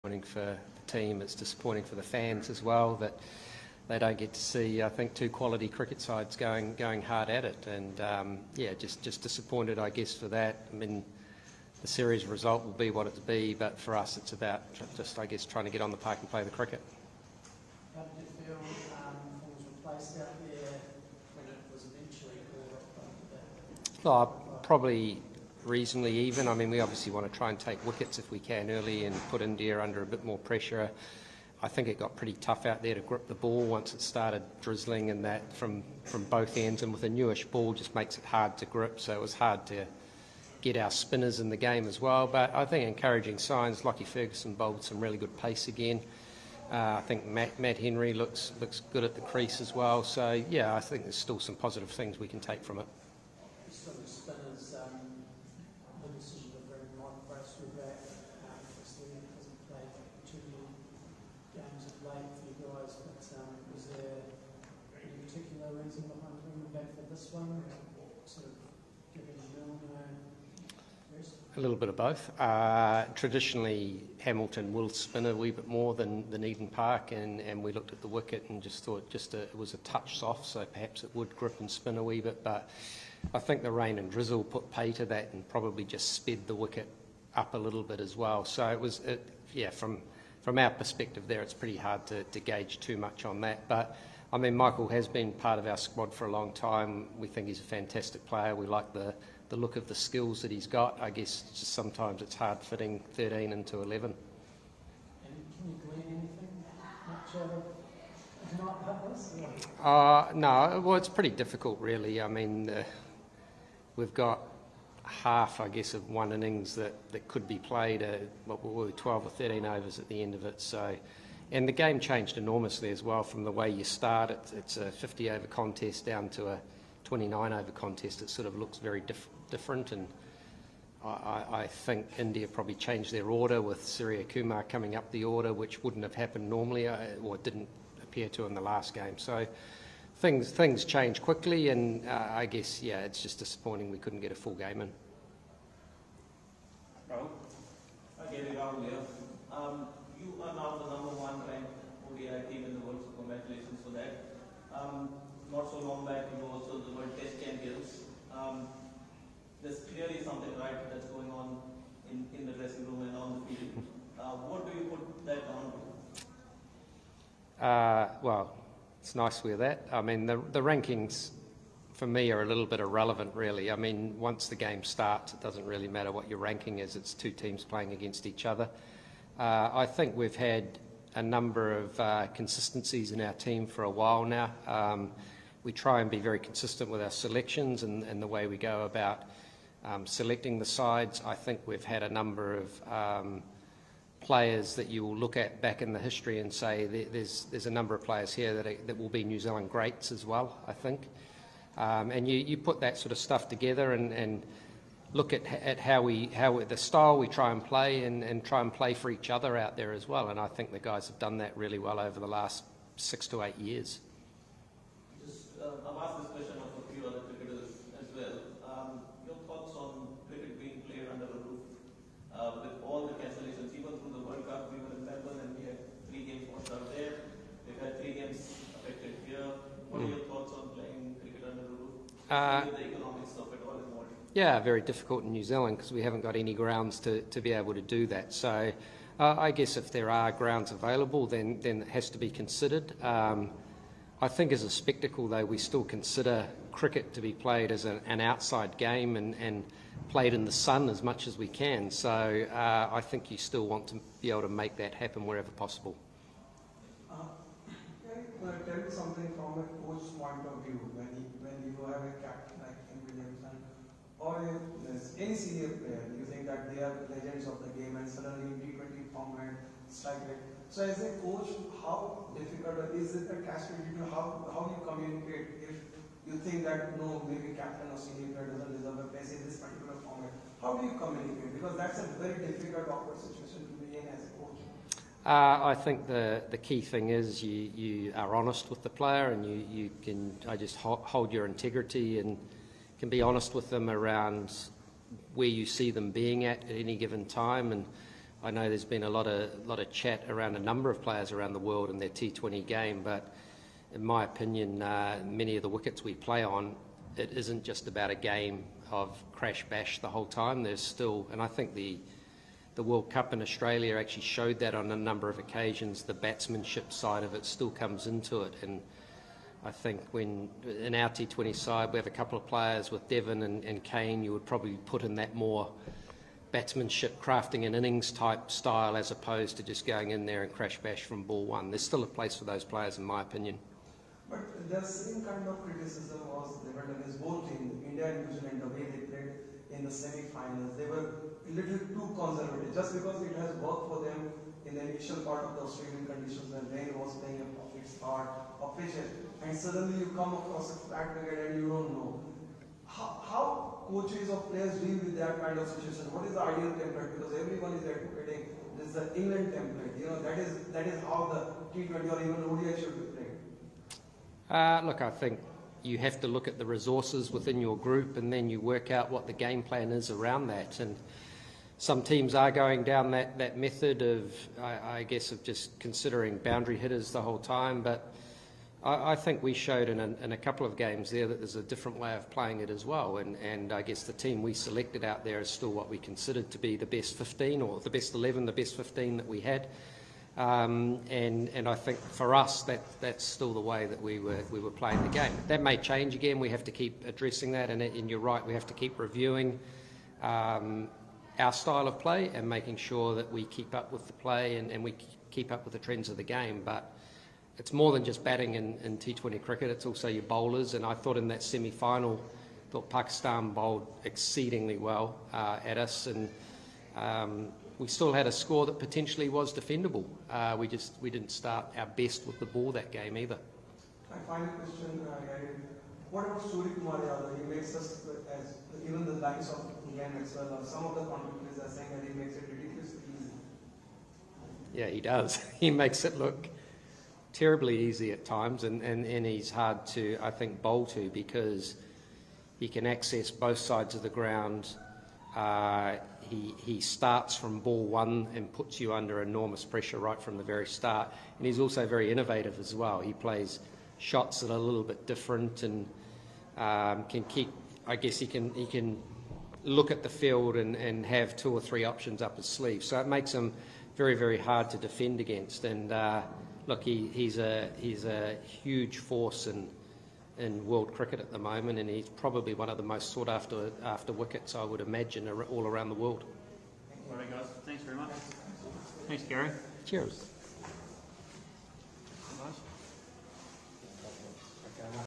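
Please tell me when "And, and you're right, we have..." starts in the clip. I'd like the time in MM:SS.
06:37.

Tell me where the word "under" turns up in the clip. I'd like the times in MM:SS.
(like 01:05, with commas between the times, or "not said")
00:29, 07:28.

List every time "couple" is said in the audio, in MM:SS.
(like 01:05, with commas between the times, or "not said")
05:22, 06:20.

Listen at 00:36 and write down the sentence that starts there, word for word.
And with a newish ball, just makes it hard to grip.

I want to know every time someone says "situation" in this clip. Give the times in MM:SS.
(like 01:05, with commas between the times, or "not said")
04:43, 05:55.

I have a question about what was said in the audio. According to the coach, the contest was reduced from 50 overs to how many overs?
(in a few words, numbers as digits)
29.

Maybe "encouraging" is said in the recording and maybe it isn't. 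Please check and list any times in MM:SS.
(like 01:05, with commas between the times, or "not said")
00:42.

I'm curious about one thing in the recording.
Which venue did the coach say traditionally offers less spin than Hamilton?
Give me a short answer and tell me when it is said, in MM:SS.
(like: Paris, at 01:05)
Eden Park, at 01:16.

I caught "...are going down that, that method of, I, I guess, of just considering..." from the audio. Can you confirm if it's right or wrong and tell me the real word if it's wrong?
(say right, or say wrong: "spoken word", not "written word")
right.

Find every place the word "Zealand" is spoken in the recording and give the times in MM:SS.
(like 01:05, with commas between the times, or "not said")
03:19, 03:55, 05:38.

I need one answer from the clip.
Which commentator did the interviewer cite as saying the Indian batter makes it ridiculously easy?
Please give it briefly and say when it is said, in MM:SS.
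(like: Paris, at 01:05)
Ian Maxwell, at 07:09.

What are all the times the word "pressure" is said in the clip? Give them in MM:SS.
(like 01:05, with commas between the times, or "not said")
00:30, 07:29.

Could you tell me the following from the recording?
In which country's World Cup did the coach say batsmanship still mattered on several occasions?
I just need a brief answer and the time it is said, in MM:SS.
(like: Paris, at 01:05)
Australia, at 05:13.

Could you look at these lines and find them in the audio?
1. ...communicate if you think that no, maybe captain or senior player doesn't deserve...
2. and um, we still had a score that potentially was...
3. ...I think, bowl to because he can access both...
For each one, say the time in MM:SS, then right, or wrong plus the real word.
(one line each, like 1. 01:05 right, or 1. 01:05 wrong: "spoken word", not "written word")
1. 04:34 right
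2. 06:56 right
3. 07:20 right.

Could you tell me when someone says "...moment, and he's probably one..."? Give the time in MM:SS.
07:51.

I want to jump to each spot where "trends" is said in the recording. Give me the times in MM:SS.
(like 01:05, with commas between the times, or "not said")
06:45.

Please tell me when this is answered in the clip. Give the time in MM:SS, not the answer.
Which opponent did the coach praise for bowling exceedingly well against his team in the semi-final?
06:52.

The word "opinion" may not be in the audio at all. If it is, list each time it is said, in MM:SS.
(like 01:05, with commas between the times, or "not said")
05:04, 05:33.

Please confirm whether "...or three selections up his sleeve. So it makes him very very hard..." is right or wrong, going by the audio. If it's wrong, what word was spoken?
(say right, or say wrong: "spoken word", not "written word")
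wrong: "options", not "selections".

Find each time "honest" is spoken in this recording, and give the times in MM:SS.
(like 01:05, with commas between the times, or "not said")
04:48, 04:53.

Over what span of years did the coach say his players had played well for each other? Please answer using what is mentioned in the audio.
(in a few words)
6 to 8 years.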